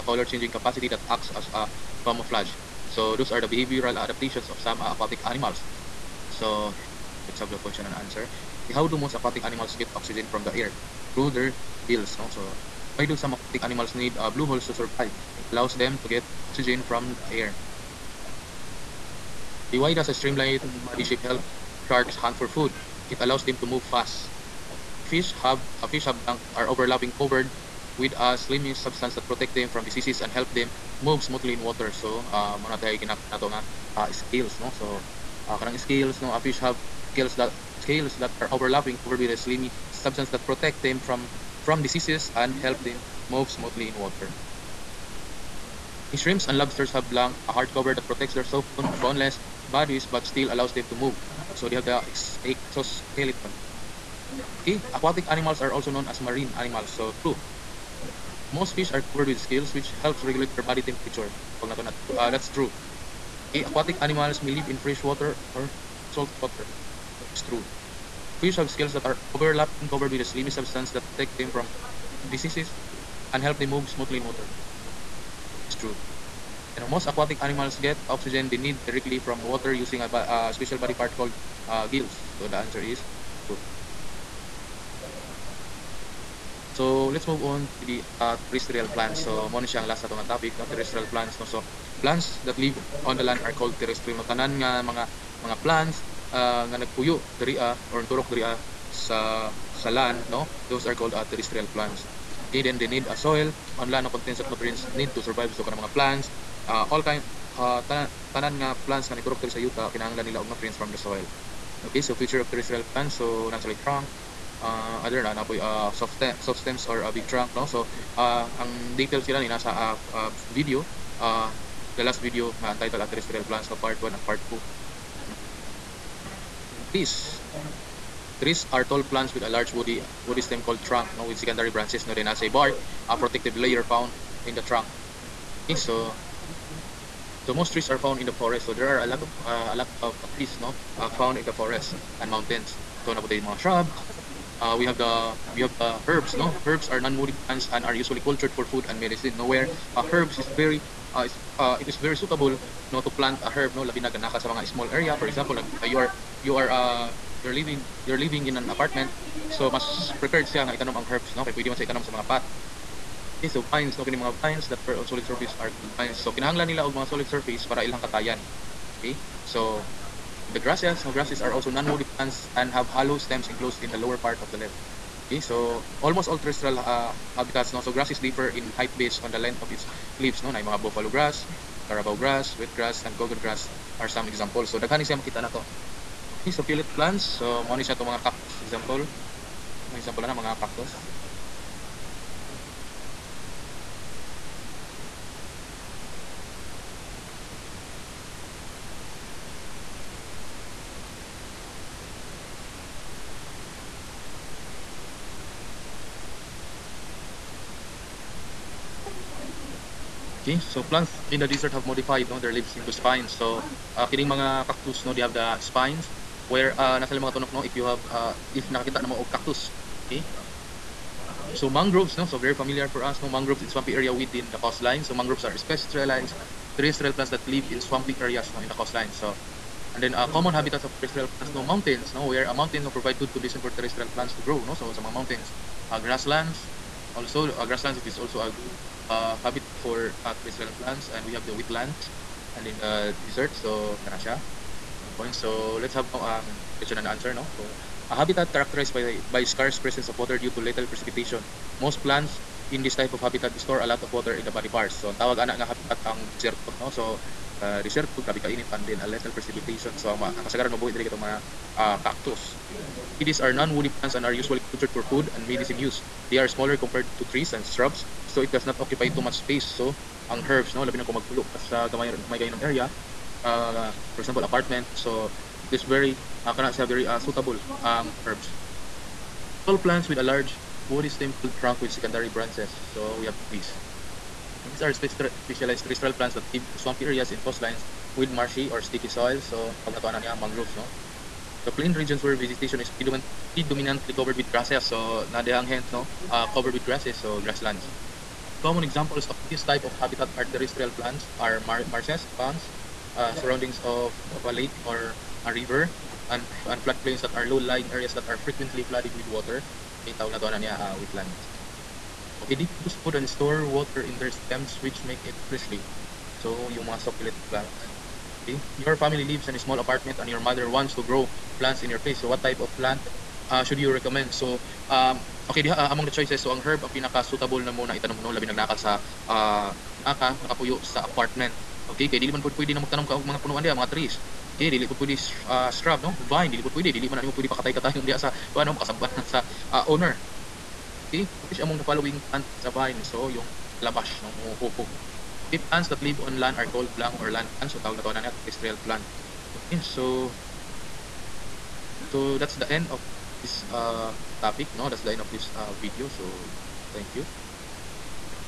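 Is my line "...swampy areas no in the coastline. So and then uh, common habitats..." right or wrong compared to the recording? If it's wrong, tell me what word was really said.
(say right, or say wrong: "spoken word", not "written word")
right.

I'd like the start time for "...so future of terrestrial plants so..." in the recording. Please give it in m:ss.
1:52.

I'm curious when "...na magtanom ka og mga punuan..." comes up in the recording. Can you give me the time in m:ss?
5:32.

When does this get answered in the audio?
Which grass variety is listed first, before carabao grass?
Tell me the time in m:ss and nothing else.
3:00.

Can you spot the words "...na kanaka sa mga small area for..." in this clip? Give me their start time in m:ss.
2:34.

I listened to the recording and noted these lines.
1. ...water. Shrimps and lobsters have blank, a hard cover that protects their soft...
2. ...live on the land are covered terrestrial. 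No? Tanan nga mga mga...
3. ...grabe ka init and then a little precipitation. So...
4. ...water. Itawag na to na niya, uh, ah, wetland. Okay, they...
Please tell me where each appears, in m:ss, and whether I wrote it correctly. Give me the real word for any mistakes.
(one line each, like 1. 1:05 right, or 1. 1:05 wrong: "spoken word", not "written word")
1. 0:43 right
2. 1:32 wrong: "called", not "covered"
3. 4:18 right
4. 5:09 right.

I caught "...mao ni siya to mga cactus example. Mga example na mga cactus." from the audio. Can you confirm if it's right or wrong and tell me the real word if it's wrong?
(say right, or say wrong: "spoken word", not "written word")
right.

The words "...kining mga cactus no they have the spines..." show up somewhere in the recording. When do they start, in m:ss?
3:34.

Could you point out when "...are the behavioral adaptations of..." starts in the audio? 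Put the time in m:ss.
0:03.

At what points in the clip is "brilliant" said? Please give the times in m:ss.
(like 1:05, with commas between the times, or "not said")
not said.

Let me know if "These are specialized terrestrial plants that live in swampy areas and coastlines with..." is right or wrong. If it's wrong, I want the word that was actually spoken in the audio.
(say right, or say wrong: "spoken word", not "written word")
right.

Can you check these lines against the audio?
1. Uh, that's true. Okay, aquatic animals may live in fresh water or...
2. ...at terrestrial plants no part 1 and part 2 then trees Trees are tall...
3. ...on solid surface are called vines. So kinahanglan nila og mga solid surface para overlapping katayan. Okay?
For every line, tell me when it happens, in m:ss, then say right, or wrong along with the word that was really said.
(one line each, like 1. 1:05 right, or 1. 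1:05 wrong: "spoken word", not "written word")
1. 1:01 right
2. 2:03 right
3. 2:44 wrong: "ilang", not "overlapping".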